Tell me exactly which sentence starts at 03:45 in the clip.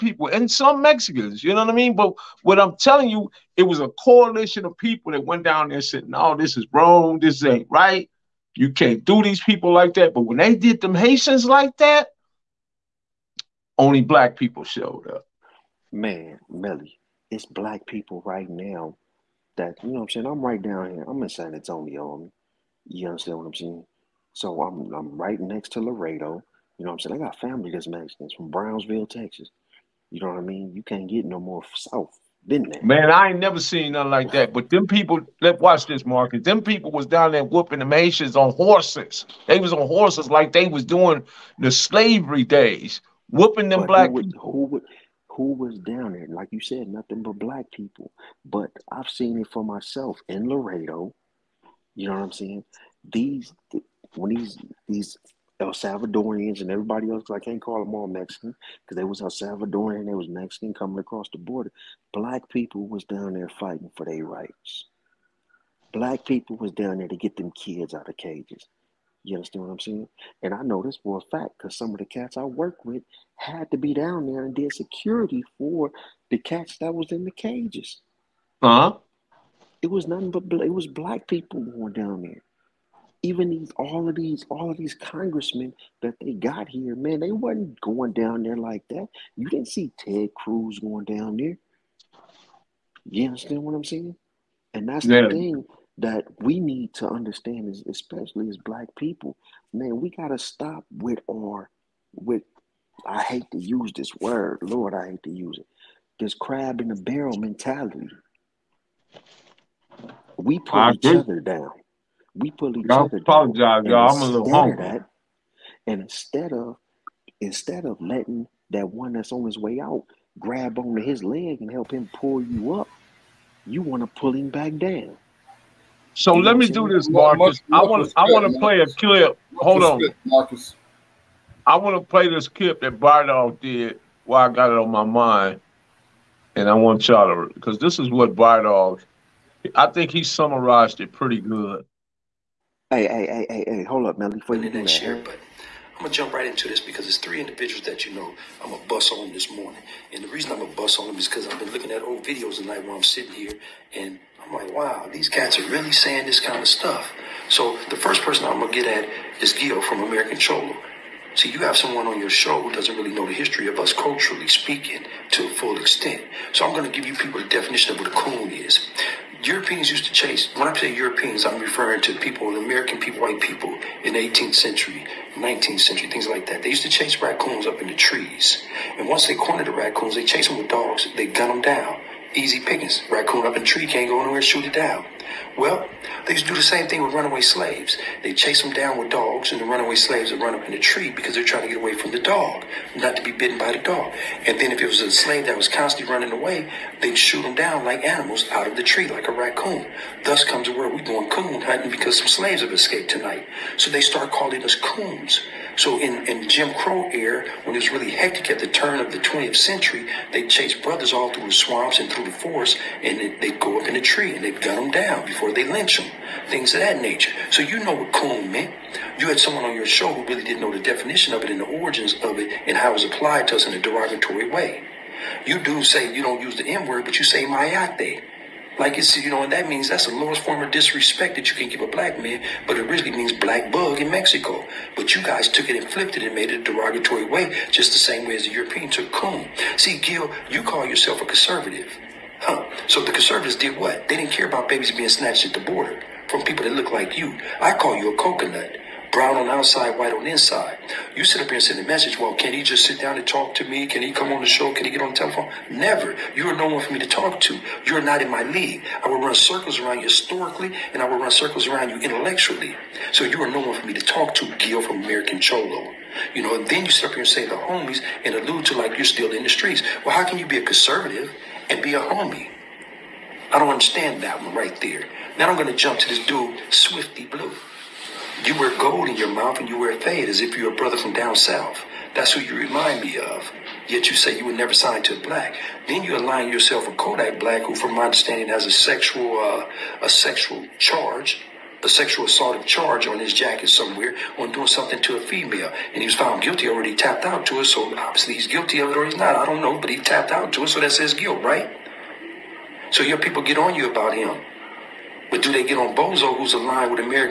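You do say you don't use the N word, but you say mayate.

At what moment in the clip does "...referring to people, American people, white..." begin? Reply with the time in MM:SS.
02:51.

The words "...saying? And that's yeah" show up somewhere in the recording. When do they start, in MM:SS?
01:33.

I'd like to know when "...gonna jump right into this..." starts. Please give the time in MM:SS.
02:26.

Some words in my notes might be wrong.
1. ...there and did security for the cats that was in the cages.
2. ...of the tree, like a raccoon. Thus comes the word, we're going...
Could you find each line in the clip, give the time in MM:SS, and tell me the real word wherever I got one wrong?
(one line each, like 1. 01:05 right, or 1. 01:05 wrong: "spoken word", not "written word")
1. 01:14 right
2. 03:18 right.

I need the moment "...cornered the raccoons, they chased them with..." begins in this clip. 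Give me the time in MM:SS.
02:59.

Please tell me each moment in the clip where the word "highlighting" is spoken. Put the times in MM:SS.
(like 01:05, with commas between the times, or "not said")
not said.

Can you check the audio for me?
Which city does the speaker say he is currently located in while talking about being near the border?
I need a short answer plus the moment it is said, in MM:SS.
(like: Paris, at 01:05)
San Antonio, at 00:21.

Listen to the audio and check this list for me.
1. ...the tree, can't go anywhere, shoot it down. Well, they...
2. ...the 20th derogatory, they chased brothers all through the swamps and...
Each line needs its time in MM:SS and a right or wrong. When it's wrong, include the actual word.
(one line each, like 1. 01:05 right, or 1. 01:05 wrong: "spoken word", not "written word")
1. 03:03 right
2. 03:29 wrong: "century", not "derogatory".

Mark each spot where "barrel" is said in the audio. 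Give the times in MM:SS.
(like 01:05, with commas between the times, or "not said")
01:46.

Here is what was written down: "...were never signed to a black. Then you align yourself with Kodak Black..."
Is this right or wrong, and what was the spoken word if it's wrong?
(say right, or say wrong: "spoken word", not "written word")
right.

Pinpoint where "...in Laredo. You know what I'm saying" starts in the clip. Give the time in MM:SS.
00:50.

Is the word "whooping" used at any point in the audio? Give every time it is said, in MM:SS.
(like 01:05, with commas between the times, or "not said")
00:37, 00:43.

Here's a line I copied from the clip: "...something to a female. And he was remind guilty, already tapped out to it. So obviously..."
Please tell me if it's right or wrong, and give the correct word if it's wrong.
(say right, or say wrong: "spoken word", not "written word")
wrong: "found", not "remind".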